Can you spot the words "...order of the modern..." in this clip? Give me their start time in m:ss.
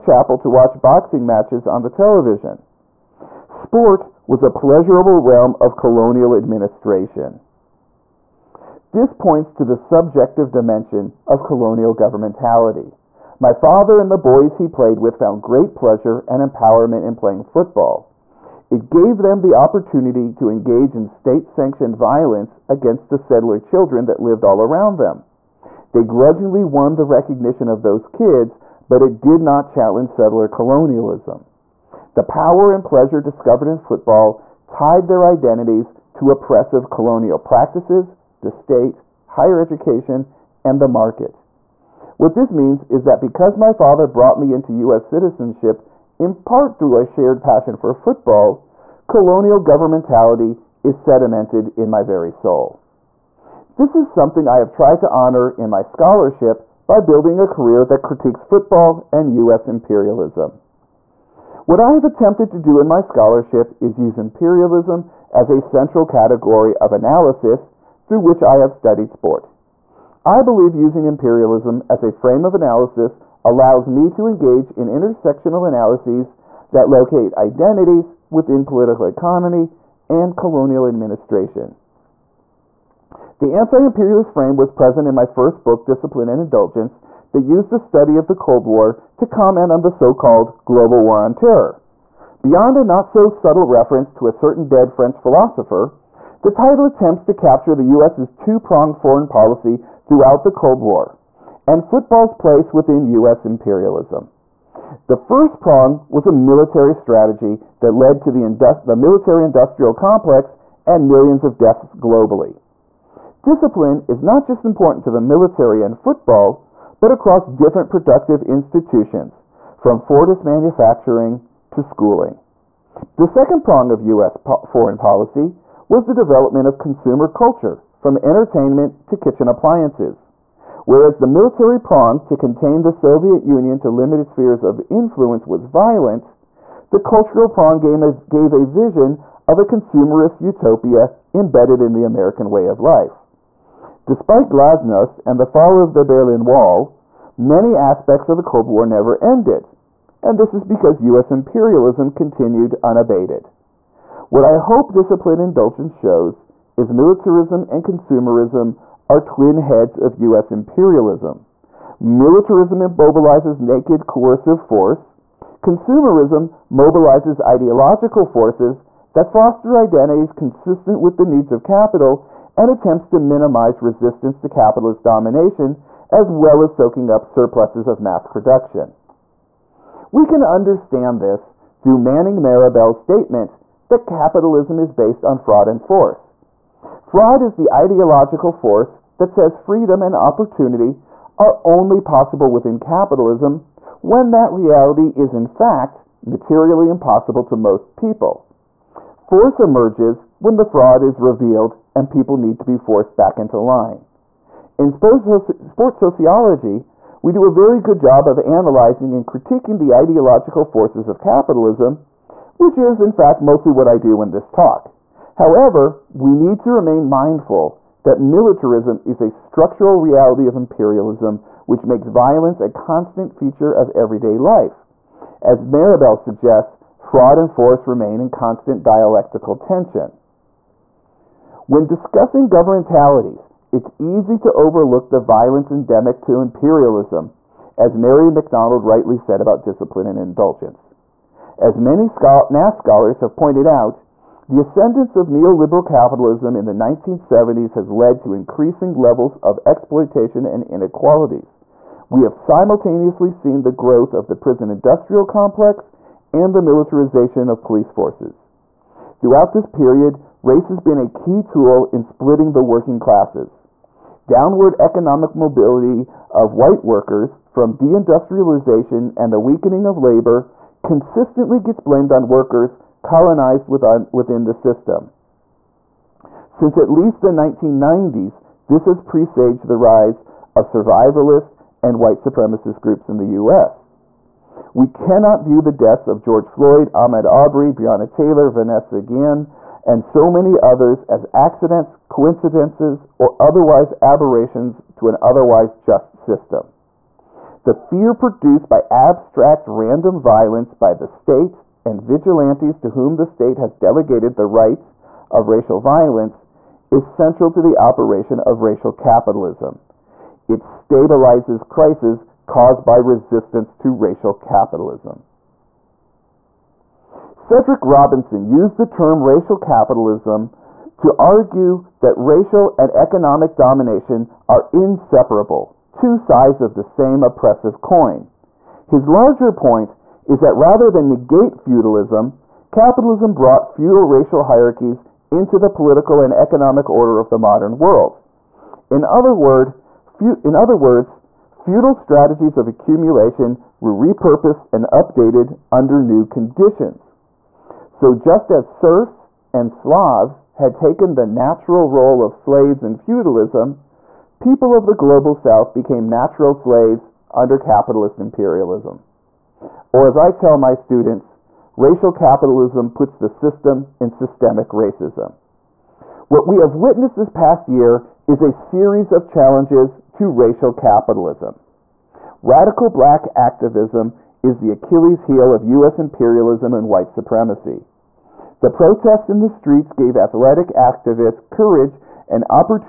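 5:36.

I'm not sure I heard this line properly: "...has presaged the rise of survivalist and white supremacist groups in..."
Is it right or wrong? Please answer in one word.
right.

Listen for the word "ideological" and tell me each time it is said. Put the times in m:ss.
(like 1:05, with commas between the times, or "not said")
2:47, 3:07, 3:29.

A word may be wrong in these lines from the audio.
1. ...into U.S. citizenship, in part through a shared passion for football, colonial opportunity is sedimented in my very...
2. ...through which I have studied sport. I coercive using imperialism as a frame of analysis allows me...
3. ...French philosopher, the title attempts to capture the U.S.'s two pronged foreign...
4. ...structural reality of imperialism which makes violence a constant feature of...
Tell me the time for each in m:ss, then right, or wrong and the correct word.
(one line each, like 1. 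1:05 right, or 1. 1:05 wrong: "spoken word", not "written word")
1. 0:44 wrong: "governmentality", not "opportunity"
2. 1:08 wrong: "believe", not "coercive"
3. 1:34 right
4. 3:39 right.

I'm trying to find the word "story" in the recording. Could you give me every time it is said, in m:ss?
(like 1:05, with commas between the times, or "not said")
not said.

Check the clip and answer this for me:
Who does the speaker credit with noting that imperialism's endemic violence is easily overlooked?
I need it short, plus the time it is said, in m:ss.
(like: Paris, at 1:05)
Mary McDonald, at 3:57.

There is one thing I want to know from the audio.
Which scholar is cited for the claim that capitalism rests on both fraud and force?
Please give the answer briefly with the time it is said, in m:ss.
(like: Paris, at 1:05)
Manning Marable, at 3:01.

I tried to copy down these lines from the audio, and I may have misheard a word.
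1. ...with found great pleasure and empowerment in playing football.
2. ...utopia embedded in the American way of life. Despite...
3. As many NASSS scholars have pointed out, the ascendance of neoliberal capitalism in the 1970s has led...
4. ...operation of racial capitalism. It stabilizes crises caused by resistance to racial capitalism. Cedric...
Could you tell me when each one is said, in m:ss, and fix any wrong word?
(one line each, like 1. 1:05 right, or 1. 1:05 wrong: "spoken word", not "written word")
1. 0:14 right
2. 2:20 right
3. 4:01 right
4. 5:07 right.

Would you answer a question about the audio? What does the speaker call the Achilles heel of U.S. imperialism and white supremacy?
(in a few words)
Radical black activism.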